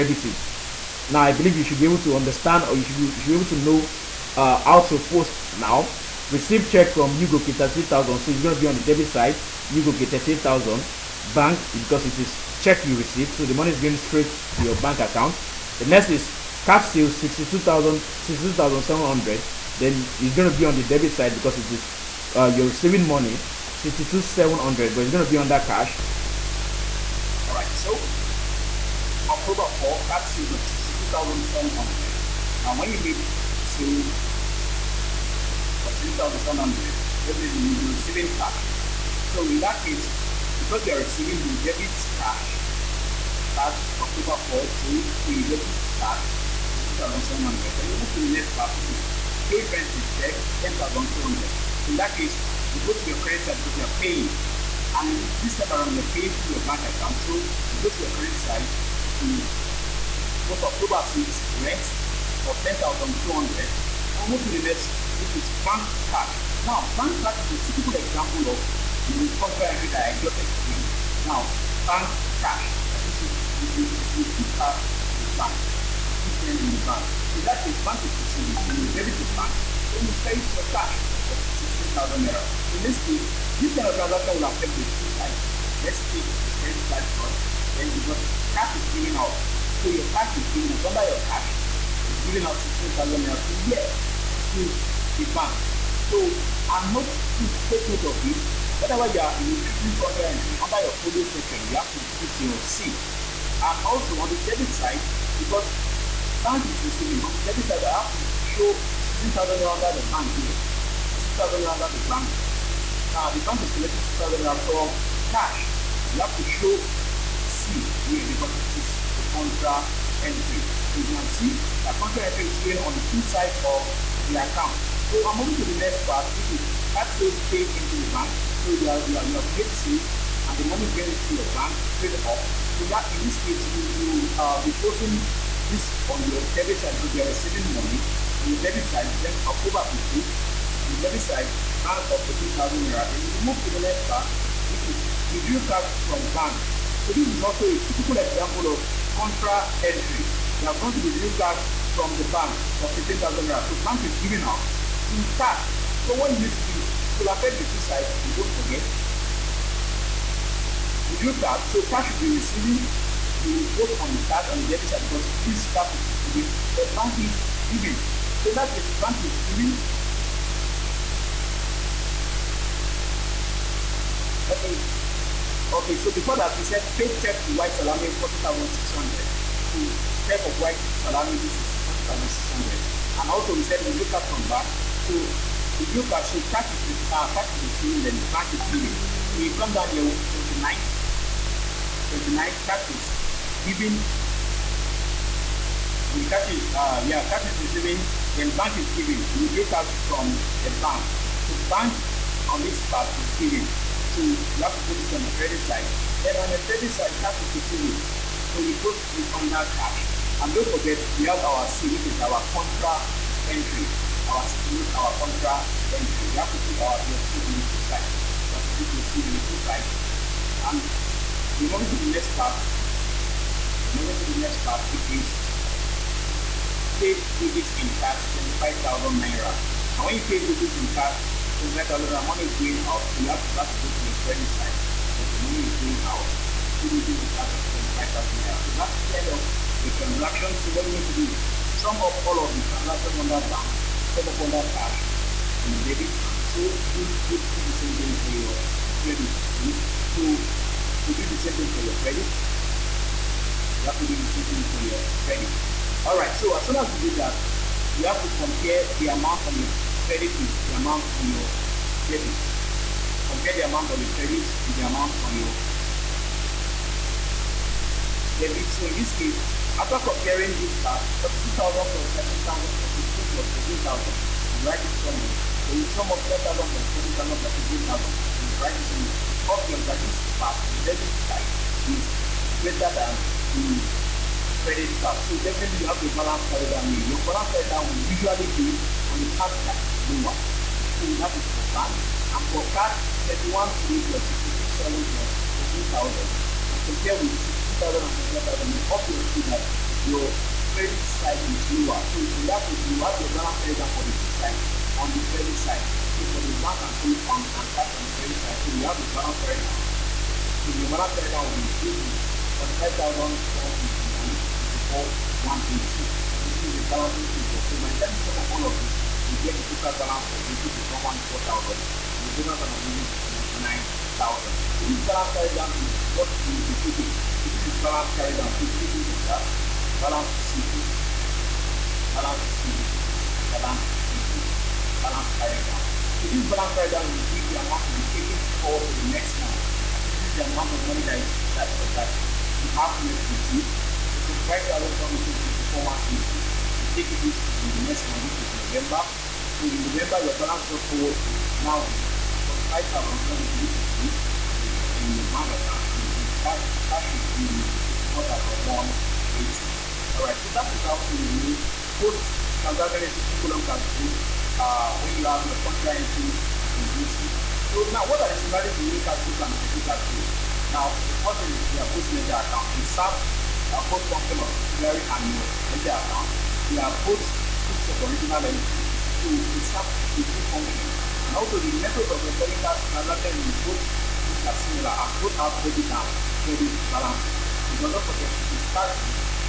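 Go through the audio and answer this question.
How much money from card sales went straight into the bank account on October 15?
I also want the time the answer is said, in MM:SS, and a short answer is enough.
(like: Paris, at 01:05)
18,000 naira, at 02:22.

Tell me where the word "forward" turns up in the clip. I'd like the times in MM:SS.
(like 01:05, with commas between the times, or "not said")
05:38, 05:50.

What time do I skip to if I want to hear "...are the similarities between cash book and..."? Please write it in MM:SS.
06:08.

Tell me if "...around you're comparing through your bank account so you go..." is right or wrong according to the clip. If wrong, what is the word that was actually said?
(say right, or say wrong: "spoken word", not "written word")
wrong: "paying", not "comparing".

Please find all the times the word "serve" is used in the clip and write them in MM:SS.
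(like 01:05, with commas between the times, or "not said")
06:12, 06:19.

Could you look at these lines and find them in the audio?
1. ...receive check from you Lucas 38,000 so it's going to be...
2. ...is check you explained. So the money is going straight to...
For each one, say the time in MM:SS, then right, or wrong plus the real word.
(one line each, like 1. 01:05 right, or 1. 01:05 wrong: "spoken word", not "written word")
1. 00:06 wrong: "Goke", not "Lucas"
2. 00:12 wrong: "received", not "explained".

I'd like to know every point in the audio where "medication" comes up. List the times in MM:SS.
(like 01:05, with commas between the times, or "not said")
not said.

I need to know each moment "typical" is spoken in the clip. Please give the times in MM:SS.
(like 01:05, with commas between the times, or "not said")
01:07, 02:27.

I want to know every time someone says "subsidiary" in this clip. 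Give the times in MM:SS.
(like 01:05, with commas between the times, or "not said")
06:14.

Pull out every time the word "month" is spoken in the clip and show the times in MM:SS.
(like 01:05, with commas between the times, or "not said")
05:39, 05:48.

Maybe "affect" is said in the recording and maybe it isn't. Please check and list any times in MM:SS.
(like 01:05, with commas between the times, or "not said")
01:24, 02:37.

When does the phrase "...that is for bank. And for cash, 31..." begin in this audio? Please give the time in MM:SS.
04:51.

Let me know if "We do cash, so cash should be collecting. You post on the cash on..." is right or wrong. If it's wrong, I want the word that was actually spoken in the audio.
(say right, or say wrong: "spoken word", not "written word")
wrong: "receiving", not "collecting".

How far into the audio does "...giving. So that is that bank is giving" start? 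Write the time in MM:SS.
02:47.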